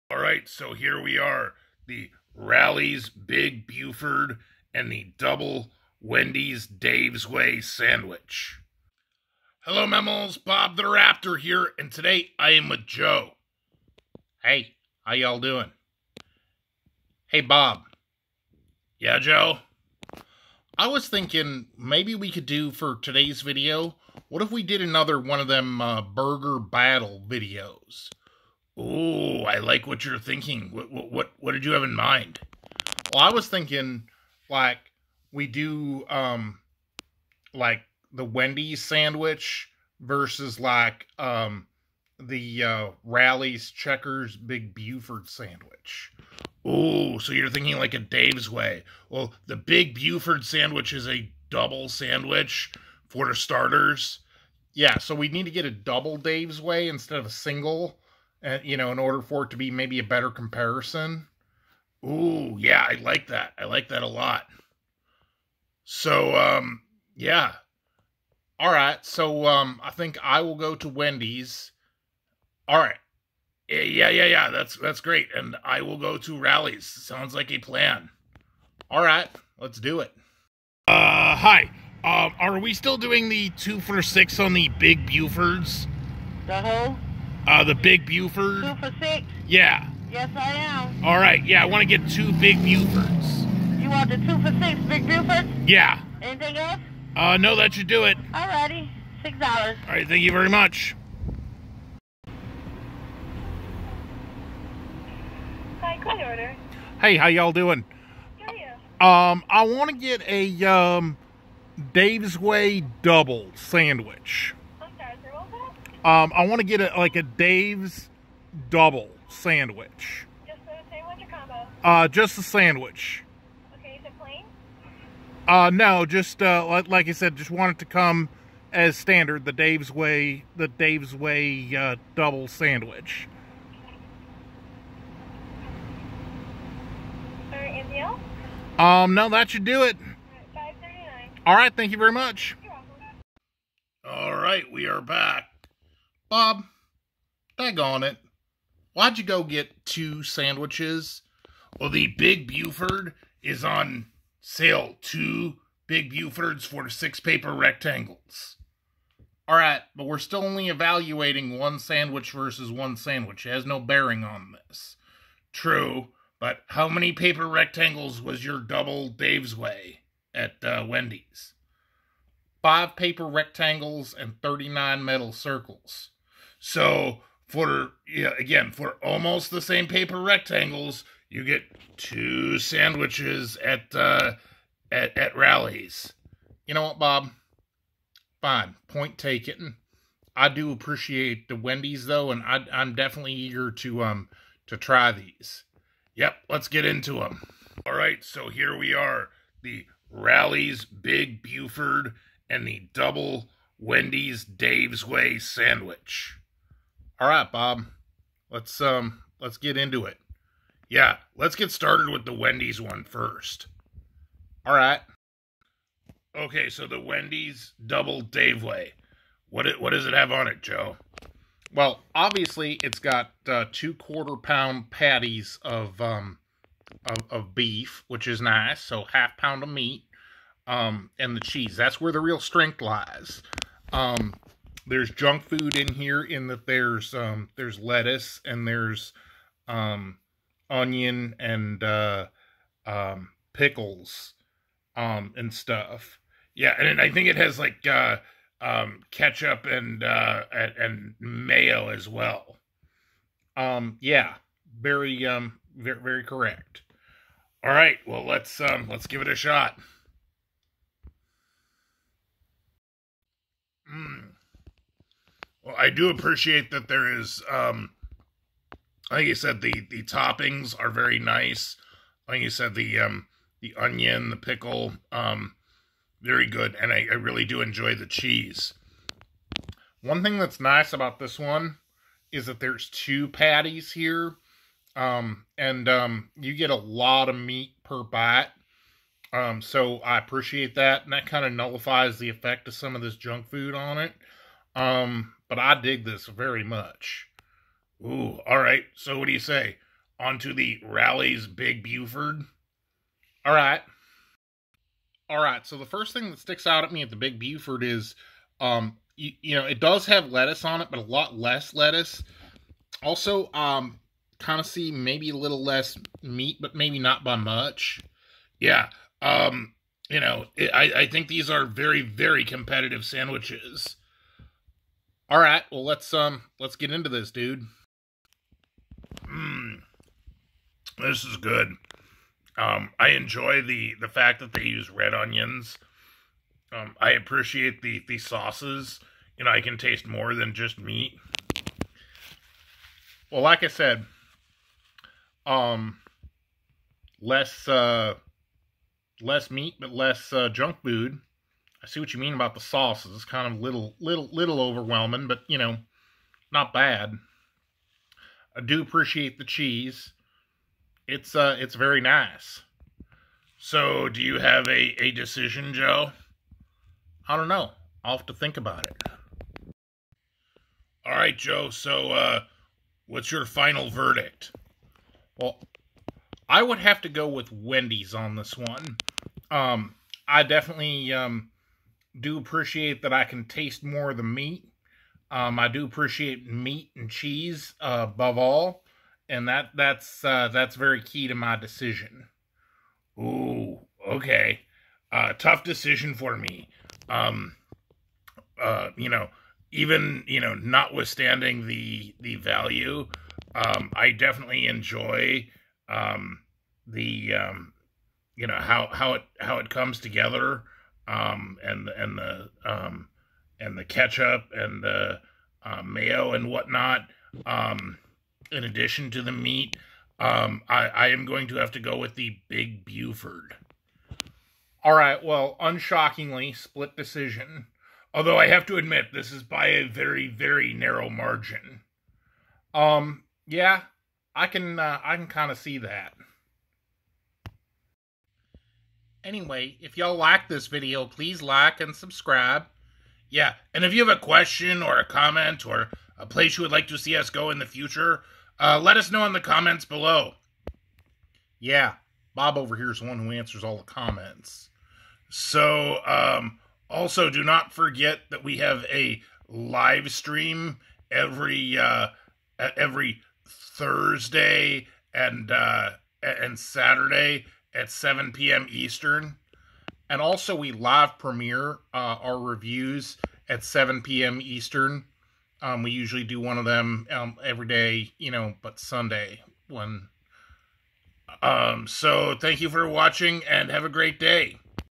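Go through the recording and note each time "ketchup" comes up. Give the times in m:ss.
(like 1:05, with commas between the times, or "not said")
4:09, 6:53.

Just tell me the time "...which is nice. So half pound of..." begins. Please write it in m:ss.
3:48.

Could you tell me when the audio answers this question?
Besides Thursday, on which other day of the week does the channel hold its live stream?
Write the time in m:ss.
7:46.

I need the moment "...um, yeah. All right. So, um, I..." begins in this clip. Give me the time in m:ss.
1:06.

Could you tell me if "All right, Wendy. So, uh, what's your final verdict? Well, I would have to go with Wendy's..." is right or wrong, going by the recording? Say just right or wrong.
wrong.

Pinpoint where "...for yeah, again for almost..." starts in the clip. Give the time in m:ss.
2:57.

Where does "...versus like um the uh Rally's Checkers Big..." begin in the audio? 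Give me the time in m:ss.
0:39.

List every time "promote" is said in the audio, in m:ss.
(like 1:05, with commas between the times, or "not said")
not said.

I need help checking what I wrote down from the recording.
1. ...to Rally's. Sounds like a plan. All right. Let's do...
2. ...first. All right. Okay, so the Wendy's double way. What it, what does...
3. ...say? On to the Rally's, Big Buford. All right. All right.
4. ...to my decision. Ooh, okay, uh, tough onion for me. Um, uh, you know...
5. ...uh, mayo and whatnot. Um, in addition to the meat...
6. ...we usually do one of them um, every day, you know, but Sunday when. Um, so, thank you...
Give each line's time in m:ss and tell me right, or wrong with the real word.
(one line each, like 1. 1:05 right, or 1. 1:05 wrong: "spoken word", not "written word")
1. 1:16 right
2. 3:33 right
3. 4:59 right
4. 6:31 wrong: "decision", not "onion"
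5. 6:55 right
6. 7:55 right.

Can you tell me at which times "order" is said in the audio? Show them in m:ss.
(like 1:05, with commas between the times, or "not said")
0:58, 1:46.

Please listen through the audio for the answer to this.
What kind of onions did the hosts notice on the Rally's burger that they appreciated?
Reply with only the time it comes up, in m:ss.
5:34.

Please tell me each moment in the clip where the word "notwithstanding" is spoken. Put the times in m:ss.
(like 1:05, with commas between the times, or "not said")
6:40.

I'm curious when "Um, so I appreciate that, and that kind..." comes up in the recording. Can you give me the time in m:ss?
4:49.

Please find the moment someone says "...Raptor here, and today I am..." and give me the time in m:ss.
0:10.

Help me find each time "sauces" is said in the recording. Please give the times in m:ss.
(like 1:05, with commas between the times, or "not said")
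5:38, 5:52.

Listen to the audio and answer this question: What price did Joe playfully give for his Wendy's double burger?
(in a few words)
5 dollars and 39 cents.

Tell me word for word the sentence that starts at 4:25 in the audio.
Well, I do appreciate that there is, um, like you said, the the toppings are very nice.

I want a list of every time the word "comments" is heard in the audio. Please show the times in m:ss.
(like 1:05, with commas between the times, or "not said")
7:25, 7:29, 7:33.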